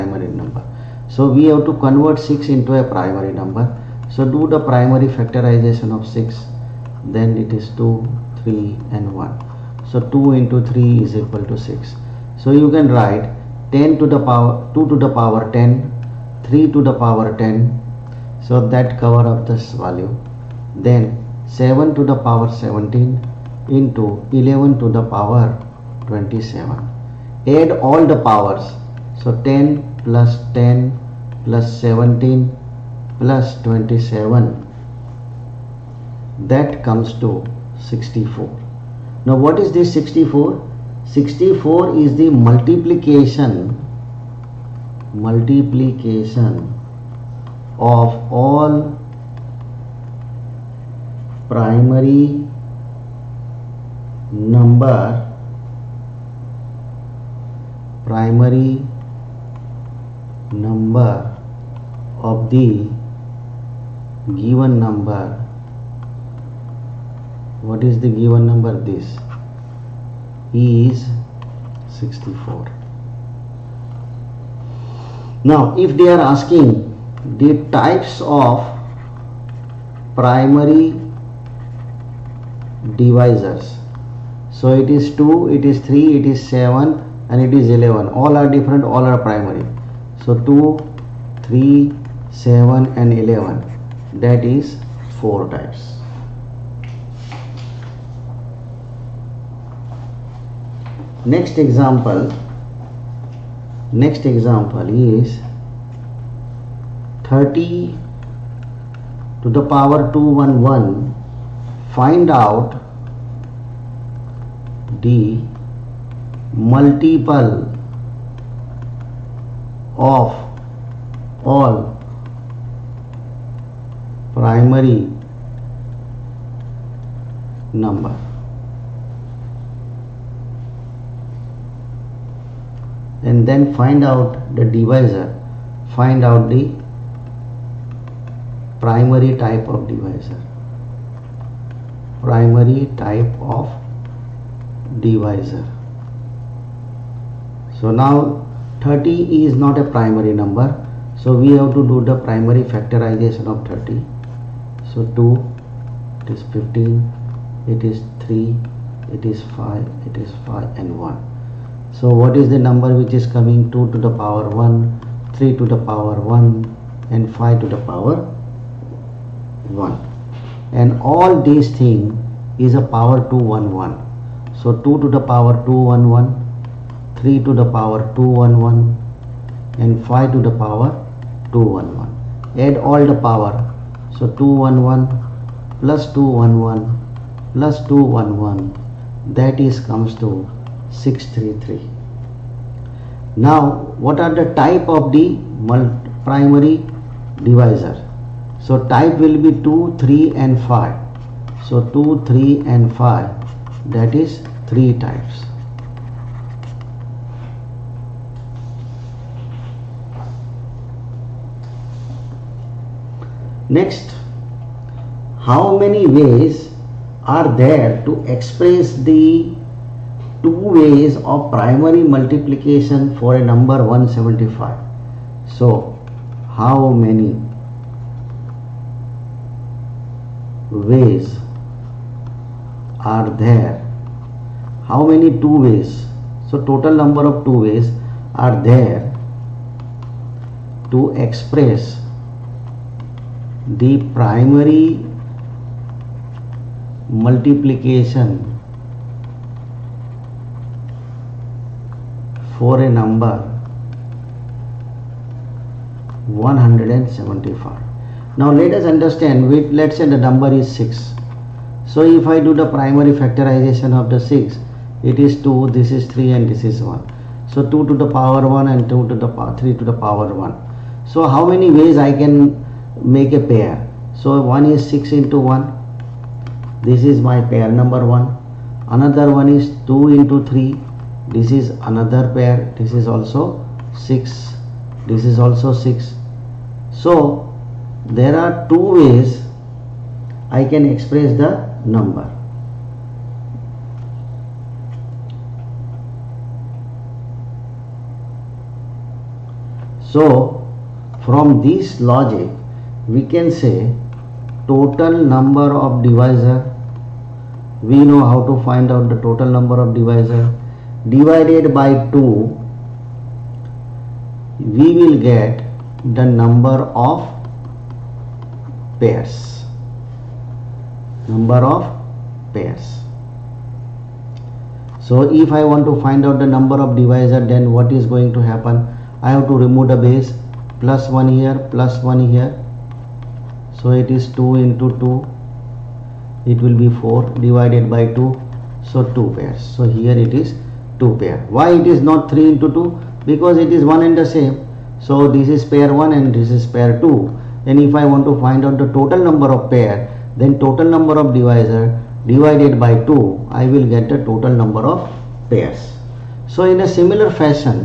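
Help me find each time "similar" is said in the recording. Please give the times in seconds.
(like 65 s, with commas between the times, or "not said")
356 s.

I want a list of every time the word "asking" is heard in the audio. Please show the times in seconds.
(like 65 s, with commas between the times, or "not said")
76 s.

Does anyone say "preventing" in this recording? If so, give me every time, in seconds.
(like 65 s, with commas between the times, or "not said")
not said.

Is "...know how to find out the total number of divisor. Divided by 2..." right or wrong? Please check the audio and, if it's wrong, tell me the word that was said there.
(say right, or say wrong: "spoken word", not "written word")
right.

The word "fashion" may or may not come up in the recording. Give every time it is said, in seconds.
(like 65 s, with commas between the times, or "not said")
357 s.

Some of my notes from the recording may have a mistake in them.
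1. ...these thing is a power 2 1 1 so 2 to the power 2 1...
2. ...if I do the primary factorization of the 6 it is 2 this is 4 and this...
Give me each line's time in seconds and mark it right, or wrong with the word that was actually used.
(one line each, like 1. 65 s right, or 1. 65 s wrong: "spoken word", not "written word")
1. 171 s right
2. 262 s wrong: "3", not "4".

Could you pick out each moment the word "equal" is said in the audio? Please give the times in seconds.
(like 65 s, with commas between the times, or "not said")
11 s.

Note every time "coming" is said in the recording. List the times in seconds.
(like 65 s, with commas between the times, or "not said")
163 s.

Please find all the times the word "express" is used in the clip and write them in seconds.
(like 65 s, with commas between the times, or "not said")
218 s, 241 s, 290 s.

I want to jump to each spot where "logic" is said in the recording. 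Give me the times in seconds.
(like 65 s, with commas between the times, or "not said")
301 s.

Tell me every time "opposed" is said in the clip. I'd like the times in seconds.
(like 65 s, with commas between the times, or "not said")
not said.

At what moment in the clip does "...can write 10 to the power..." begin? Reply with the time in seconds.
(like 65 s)
12 s.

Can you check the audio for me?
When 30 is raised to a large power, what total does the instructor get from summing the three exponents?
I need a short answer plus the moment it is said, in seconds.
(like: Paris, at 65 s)
633, at 191 s.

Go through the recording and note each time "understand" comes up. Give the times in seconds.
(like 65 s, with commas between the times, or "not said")
258 s.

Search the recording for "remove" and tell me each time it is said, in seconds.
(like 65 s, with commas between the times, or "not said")
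329 s.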